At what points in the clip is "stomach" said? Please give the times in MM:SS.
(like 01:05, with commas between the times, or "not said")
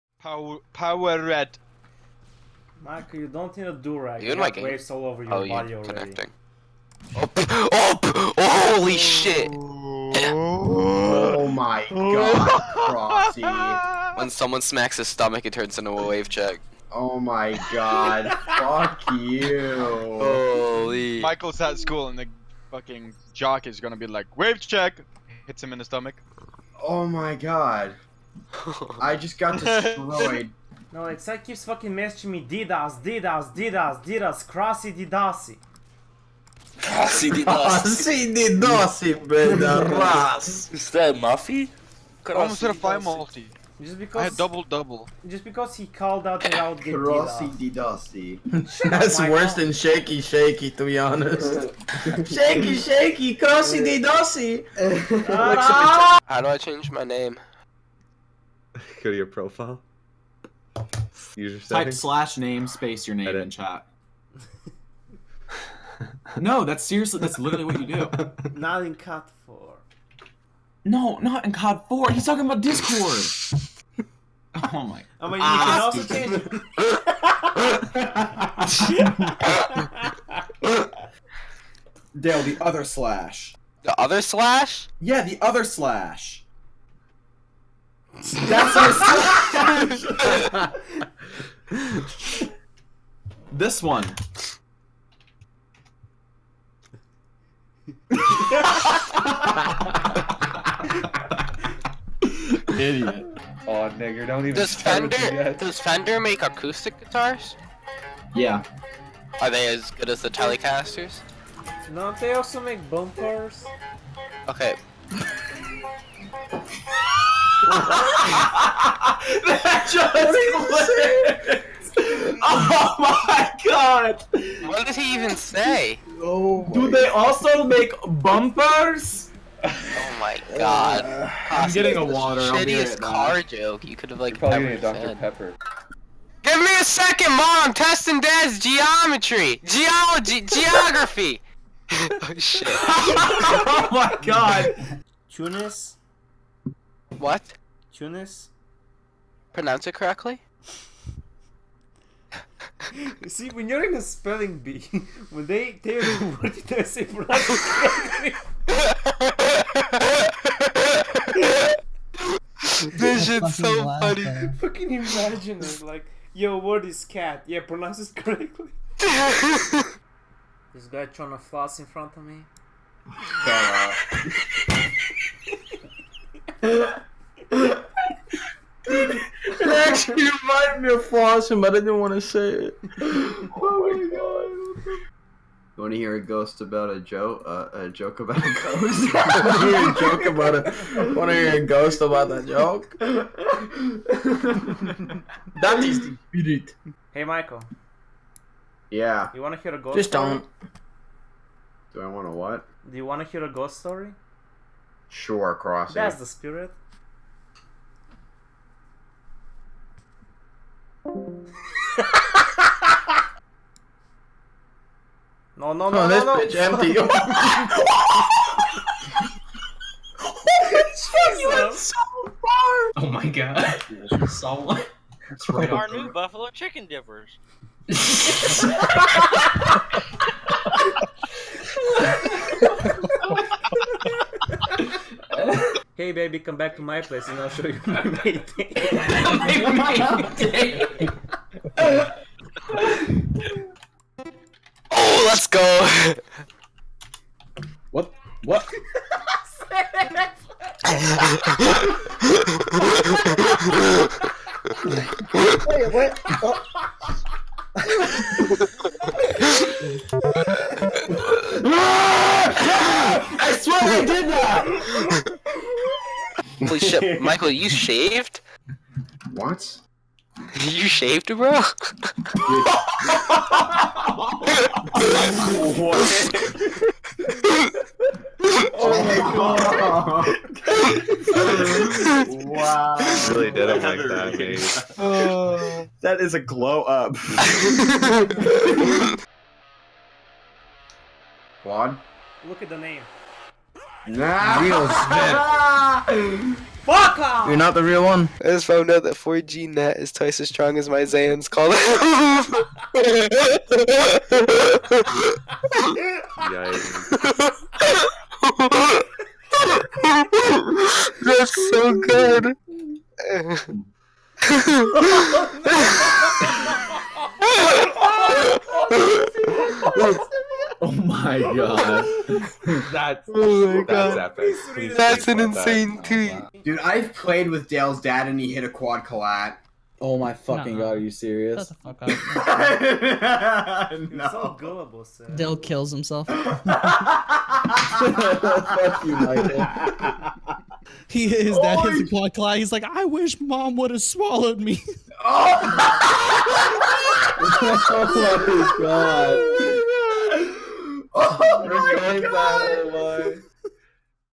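00:15, 00:25.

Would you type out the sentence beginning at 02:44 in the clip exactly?
Fucking imagine it, like, yo, word is cat.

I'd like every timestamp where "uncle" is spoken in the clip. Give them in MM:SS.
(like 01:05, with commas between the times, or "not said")
not said.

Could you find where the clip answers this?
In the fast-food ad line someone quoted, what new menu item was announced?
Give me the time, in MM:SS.
03:46.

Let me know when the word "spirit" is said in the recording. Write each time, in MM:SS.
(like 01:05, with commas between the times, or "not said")
03:16, 03:26.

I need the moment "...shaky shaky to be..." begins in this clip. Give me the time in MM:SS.
00:49.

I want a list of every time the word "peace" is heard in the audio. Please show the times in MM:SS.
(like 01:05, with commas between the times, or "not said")
not said.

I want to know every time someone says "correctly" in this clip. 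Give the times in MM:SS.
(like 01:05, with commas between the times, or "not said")
02:29, 02:38, 02:48.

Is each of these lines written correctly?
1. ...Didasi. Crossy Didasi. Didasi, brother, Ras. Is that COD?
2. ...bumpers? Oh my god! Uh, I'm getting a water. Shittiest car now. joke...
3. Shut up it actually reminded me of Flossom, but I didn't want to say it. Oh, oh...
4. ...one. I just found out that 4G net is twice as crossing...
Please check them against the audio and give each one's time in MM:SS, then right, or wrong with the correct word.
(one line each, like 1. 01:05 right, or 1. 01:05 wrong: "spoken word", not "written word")
1. 00:34 wrong: "Muffy", not "COD"
2. 02:08 right
3. 02:55 right
4. 04:58 wrong: "strong", not "crossing".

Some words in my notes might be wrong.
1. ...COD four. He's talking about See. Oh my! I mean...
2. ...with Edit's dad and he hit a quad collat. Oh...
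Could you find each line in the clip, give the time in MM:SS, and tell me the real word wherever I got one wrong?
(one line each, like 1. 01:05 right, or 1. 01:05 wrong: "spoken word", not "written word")
1. 01:11 wrong: "Discord", not "See"
2. 05:27 wrong: "Dale", not "Edit".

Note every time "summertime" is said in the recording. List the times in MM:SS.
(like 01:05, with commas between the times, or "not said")
not said.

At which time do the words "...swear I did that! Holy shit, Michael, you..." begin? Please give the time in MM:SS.
04:23.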